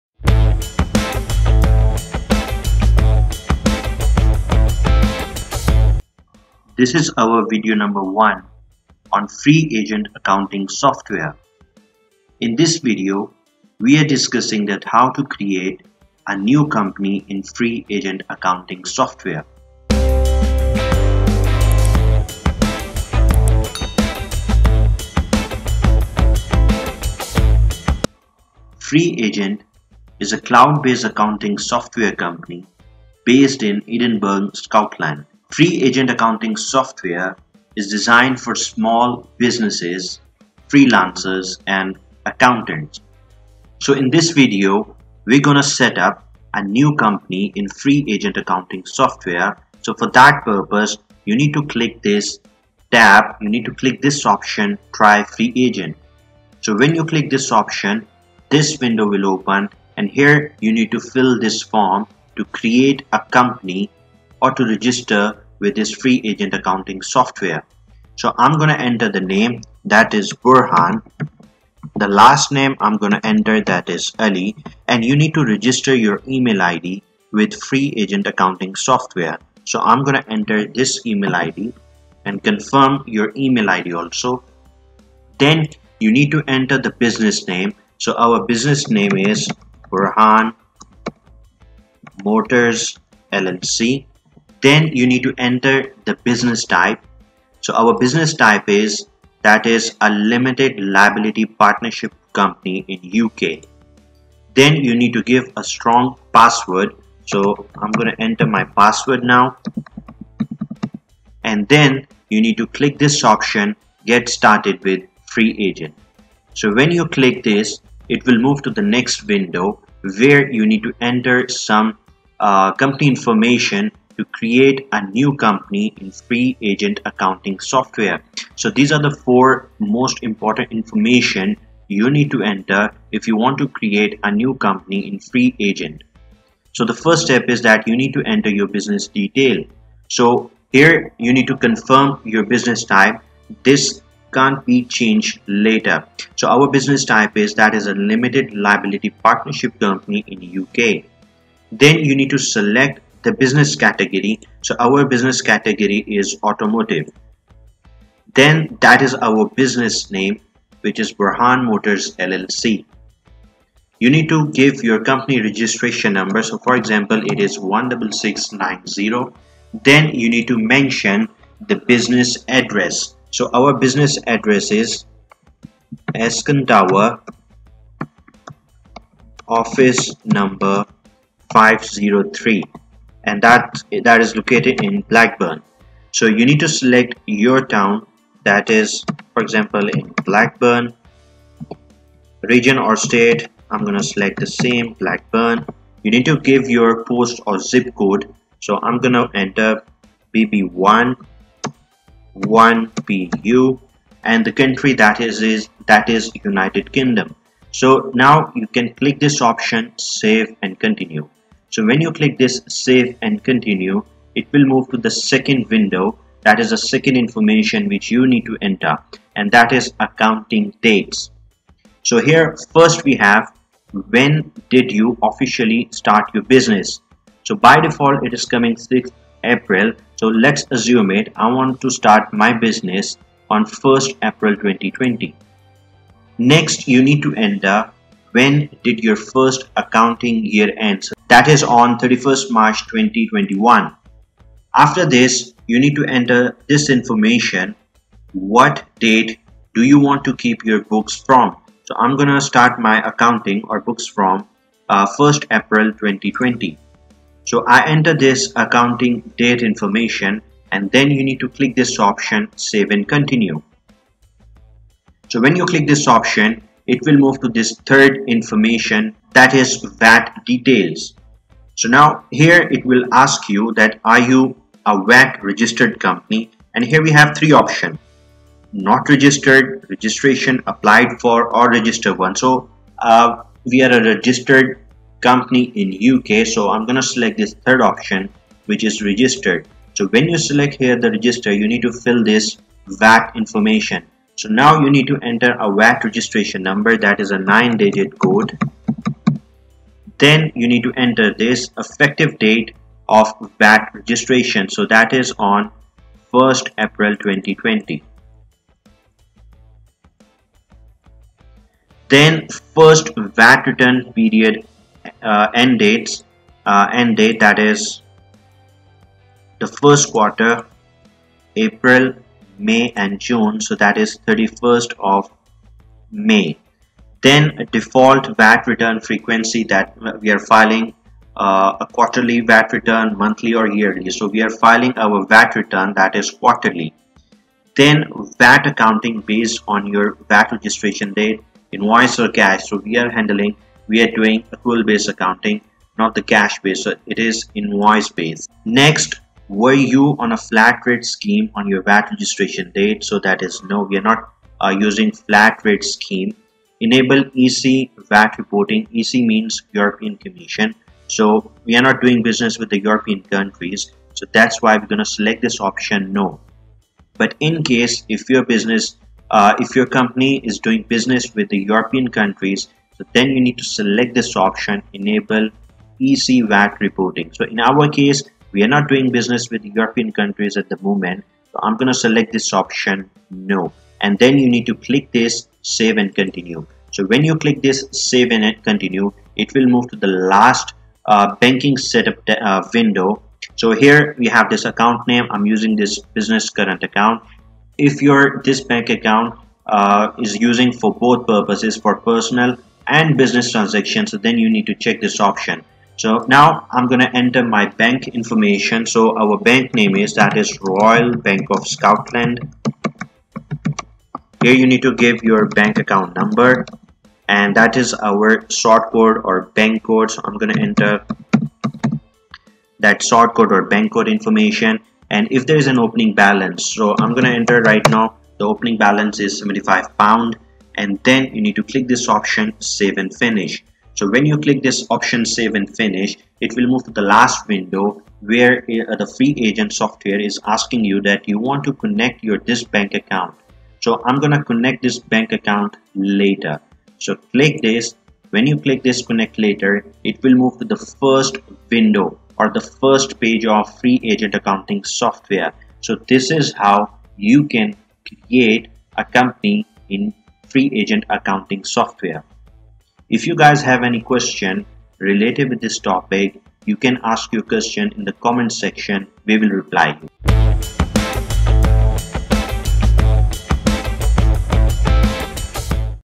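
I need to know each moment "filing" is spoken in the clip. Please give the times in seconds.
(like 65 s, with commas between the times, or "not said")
330 s, 334 s.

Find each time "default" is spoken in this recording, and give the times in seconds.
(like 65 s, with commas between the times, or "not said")
227 s, 327 s.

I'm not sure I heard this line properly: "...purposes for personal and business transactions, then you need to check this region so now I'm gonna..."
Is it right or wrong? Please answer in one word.
wrong.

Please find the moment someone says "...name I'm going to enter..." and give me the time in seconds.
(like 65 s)
72 s.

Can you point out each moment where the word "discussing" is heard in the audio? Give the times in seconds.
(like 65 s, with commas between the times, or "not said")
14 s.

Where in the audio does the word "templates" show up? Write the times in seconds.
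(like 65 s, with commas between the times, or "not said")
not said.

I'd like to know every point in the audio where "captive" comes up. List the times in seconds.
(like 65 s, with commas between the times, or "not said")
not said.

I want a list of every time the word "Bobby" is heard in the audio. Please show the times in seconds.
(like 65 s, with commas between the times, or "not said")
not said.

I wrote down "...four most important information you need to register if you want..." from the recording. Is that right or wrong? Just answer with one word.
wrong.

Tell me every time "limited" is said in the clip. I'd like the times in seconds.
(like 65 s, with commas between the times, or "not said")
100 s, 147 s.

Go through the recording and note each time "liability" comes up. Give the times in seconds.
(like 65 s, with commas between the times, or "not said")
100 s, 148 s.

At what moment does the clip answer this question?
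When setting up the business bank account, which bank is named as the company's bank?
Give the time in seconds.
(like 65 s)
410 s.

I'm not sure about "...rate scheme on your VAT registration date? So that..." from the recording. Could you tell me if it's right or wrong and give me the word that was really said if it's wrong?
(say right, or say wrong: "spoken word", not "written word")
right.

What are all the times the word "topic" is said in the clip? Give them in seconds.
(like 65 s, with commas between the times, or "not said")
465 s.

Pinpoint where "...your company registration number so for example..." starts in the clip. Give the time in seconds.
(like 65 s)
164 s.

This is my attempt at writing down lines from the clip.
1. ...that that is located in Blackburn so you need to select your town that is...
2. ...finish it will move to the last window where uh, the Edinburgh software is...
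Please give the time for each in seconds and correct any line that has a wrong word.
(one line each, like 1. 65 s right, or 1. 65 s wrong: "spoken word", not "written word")
1. 183 s right
2. 435 s wrong: "FreeAgent", not "Edinburgh".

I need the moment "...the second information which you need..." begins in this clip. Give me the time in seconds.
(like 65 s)
216 s.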